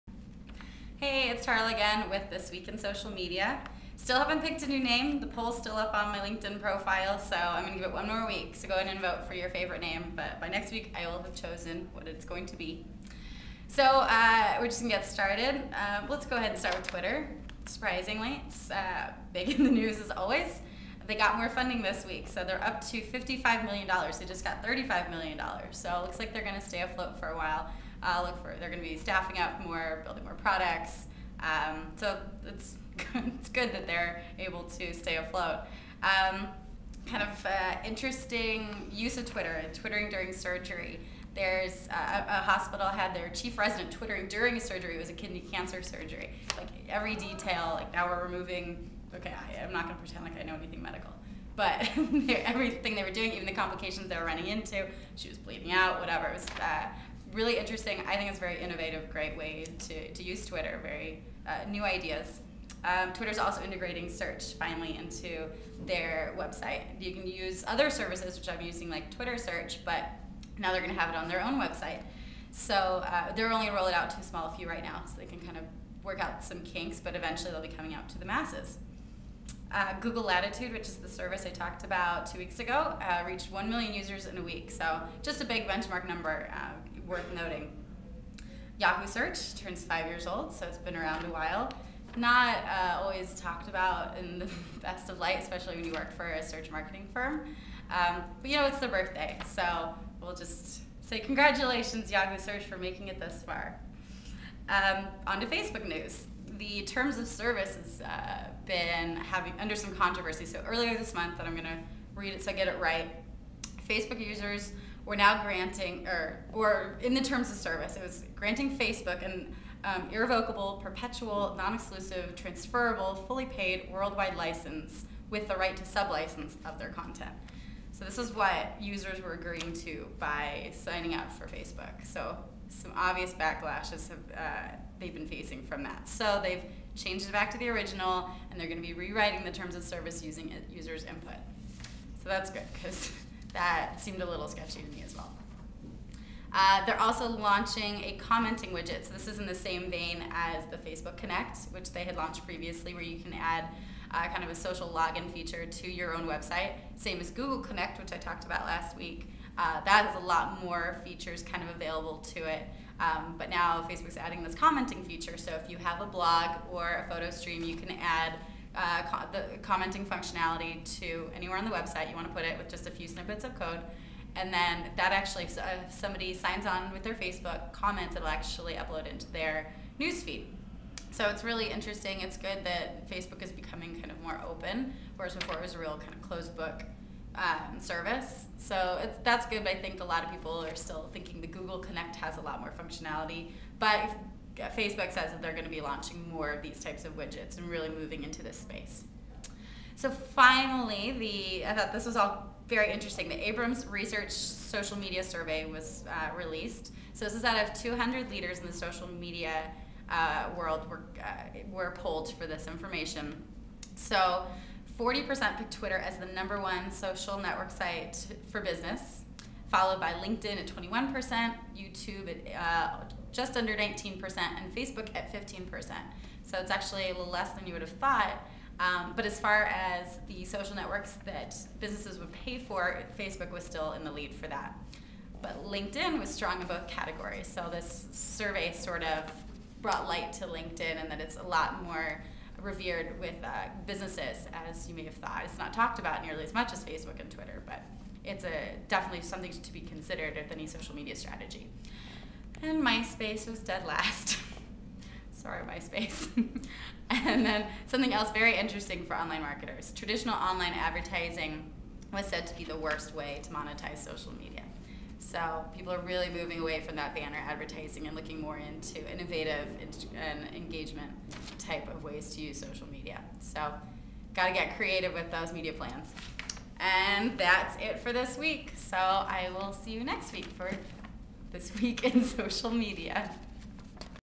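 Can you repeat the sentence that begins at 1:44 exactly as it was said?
Um, on to Facebook news the terms of service has uh, been having under some controversy.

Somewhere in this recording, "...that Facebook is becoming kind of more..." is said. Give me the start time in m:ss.
3:02.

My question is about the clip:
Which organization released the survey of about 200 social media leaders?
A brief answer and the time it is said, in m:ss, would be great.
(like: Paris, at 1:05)
Abrams Research, at 3:23.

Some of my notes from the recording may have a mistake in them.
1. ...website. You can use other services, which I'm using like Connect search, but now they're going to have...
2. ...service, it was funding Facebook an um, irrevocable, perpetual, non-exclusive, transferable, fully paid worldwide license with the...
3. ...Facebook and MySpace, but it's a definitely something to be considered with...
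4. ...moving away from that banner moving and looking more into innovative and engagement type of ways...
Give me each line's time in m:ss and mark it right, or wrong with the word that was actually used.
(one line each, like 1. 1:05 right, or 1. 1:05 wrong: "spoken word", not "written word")
1. 1:06 wrong: "Twitter", not "Connect"
2. 1:57 wrong: "granting", not "funding"
3. 4:06 wrong: "Twitter", not "MySpace"
4. 4:26 wrong: "advertising", not "moving".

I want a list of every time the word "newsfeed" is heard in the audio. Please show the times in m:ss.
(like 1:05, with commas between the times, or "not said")
2:59.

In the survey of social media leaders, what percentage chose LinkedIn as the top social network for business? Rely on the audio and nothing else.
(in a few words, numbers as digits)
21%.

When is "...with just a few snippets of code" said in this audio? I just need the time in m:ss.
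2:52.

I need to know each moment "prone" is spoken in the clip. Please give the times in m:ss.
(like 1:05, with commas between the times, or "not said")
not said.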